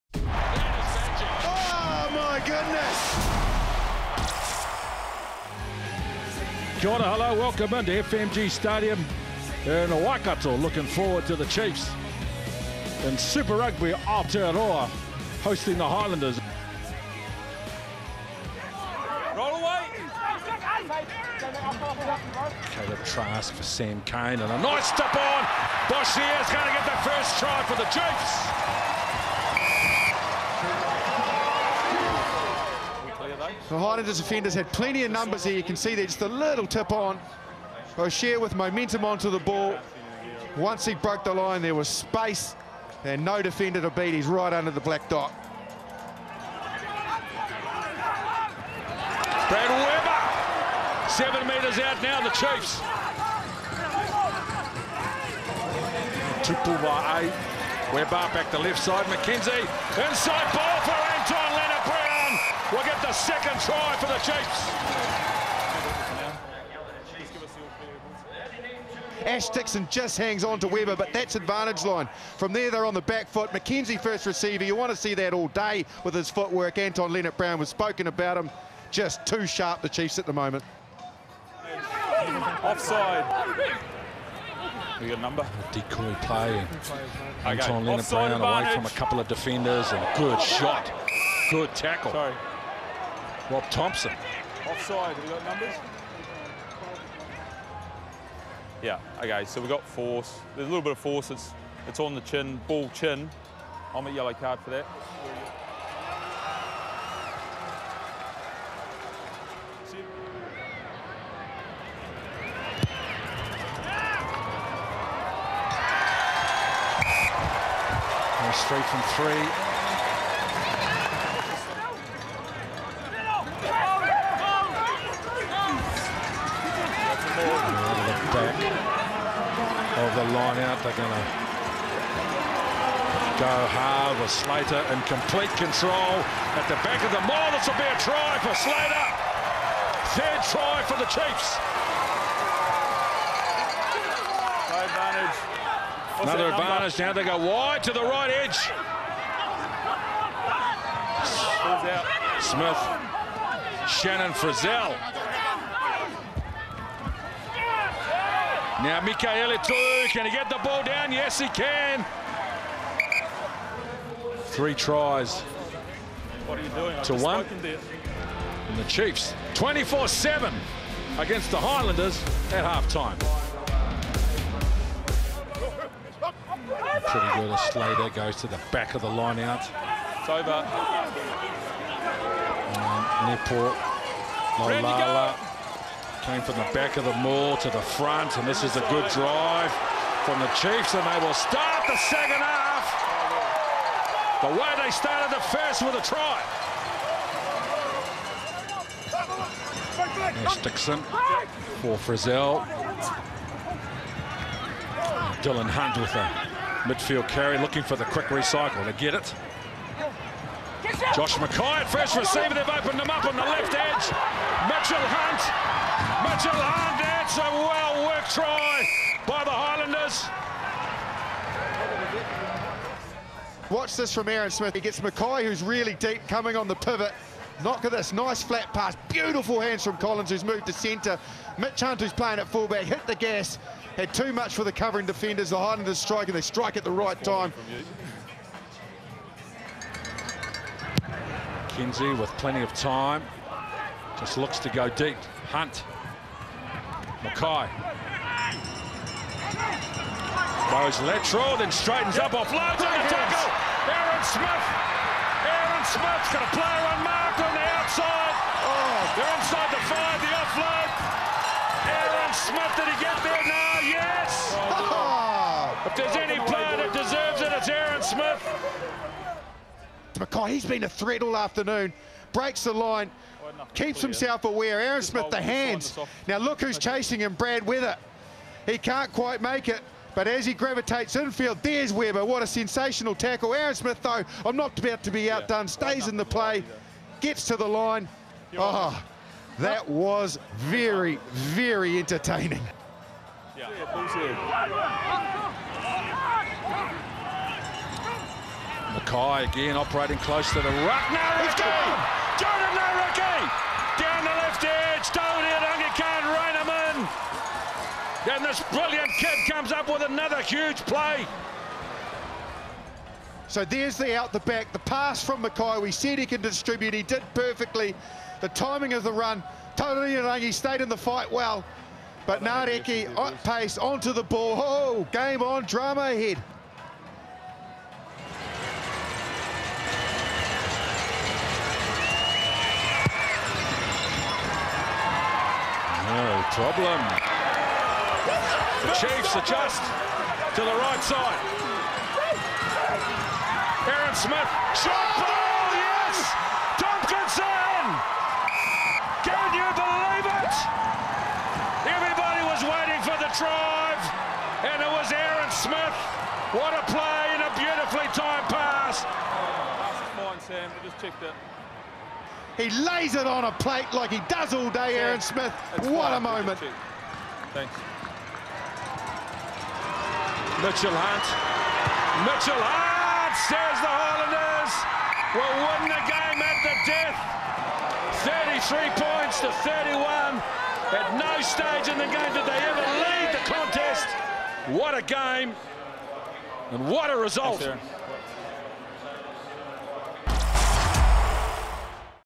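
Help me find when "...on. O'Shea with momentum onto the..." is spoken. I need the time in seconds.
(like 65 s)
36 s.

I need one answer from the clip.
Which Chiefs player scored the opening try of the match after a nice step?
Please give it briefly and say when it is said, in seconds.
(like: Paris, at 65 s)
Boshier, at 25 s.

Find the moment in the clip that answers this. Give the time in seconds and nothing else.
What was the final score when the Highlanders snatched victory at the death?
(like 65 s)
378 s.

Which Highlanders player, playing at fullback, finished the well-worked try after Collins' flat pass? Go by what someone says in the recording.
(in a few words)
Mitch Hunt.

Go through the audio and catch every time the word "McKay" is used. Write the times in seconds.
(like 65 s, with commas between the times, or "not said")
211 s, 224 s, 247 s, 298 s, 315 s.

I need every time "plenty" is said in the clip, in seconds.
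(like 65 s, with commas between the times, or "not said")
34 s, 242 s.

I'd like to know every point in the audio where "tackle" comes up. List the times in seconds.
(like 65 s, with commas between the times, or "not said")
91 s, 253 s, 283 s.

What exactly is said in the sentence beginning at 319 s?
Totally Rangi stayed in the fight well.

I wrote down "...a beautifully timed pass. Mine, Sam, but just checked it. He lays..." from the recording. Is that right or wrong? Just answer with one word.
right.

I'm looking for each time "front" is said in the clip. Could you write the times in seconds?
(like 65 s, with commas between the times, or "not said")
187 s.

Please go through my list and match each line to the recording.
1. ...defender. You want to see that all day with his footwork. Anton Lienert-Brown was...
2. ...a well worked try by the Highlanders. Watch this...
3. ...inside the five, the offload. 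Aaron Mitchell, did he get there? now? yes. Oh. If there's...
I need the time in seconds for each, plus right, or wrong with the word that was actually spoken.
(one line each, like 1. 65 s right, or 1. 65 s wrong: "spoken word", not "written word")
1. 74 s wrong: "receiver", not "defender"
2. 217 s right
3. 259 s wrong: "Smith", not "Mitchell".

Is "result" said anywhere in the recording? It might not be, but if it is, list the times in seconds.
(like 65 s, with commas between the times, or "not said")
387 s.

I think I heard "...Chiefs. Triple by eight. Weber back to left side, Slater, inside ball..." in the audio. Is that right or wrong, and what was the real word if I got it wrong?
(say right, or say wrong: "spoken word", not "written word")
wrong: "McKenzie", not "Slater".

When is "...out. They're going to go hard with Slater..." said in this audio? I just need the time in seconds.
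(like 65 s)
130 s.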